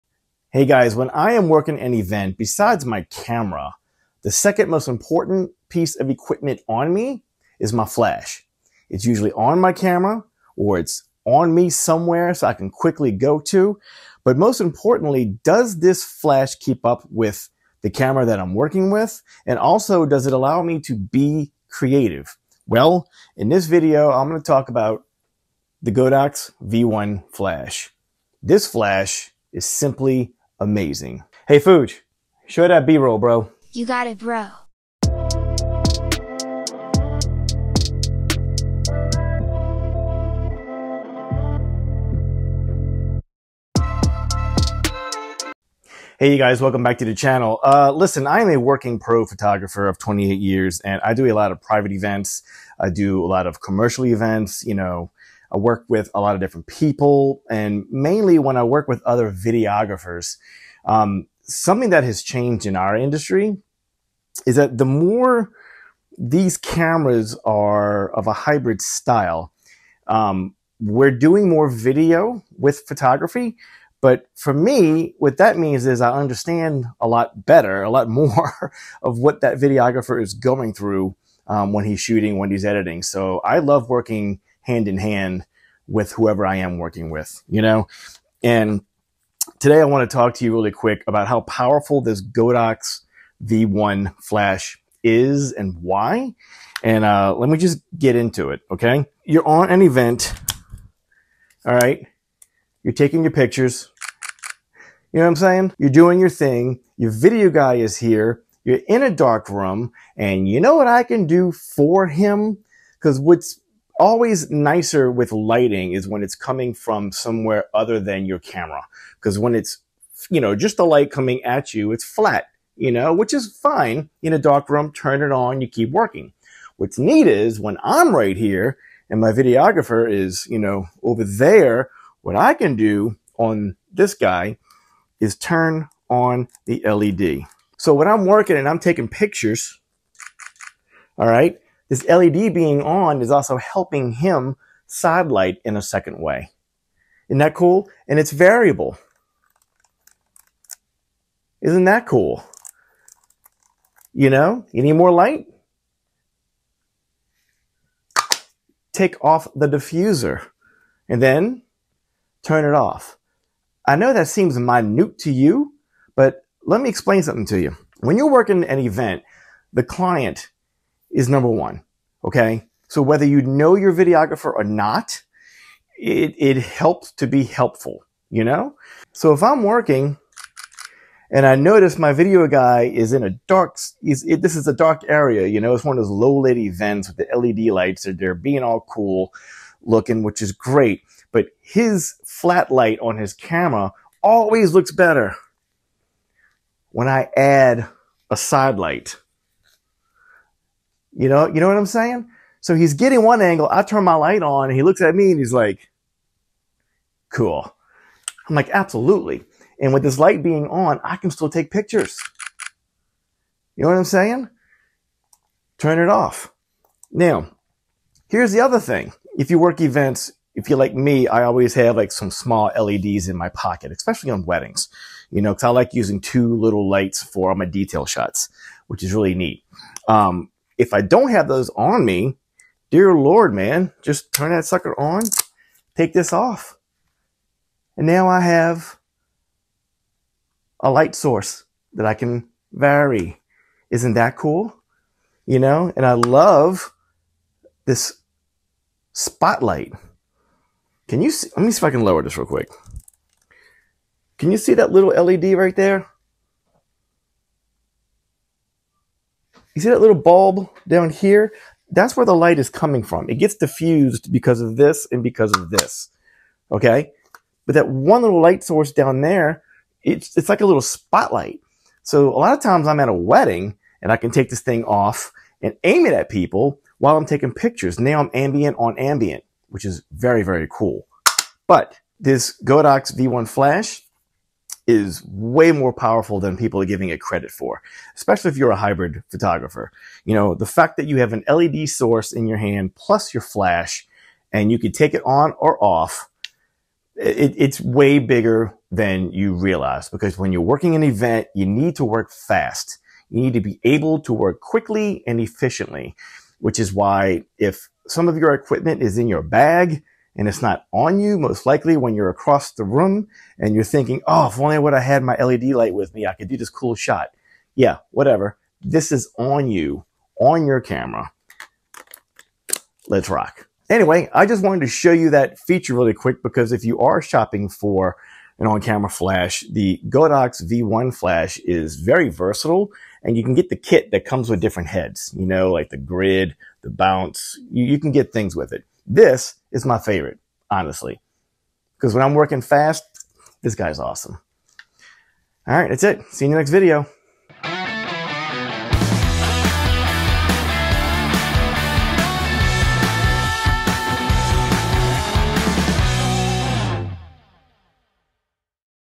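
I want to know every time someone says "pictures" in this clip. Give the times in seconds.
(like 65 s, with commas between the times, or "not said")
103 s, 139 s, 211 s, 277 s.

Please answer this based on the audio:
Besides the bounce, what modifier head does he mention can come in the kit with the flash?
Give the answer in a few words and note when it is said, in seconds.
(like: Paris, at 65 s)
grid, at 335 s.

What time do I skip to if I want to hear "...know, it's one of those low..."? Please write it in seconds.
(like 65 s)
185 s.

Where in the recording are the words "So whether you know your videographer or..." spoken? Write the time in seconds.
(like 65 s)
172 s.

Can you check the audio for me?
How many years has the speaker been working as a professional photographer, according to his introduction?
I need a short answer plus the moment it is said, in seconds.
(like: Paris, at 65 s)
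28, at 49 s.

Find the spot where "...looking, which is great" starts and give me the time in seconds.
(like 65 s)
189 s.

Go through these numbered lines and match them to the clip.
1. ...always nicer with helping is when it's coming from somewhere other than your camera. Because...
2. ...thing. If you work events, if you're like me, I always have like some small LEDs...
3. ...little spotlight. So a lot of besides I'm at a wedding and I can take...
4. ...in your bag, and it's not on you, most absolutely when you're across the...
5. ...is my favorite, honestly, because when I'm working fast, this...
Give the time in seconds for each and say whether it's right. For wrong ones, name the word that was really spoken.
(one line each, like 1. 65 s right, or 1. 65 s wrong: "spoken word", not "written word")
1. 114 s wrong: "lighting", not "helping"
2. 218 s right
3. 270 s wrong: "times", not "besides"
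4. 309 s wrong: "likely", not "absolutely"
5. 339 s right.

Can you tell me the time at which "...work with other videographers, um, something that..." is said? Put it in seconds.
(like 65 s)
58 s.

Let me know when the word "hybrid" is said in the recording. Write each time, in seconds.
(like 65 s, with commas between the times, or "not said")
68 s, 288 s.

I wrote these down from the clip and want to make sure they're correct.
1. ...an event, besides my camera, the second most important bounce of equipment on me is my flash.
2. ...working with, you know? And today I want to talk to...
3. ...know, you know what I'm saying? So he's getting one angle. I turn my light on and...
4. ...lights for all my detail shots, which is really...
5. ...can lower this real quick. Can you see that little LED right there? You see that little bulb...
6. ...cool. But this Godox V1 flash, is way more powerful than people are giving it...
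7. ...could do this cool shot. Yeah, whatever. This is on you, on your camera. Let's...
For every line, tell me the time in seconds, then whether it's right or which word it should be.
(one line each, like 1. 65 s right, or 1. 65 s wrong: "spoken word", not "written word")
1. 1 s wrong: "piece", not "bounce"
2. 86 s right
3. 201 s right
4. 226 s right
5. 251 s right
6. 280 s right
7. 316 s right.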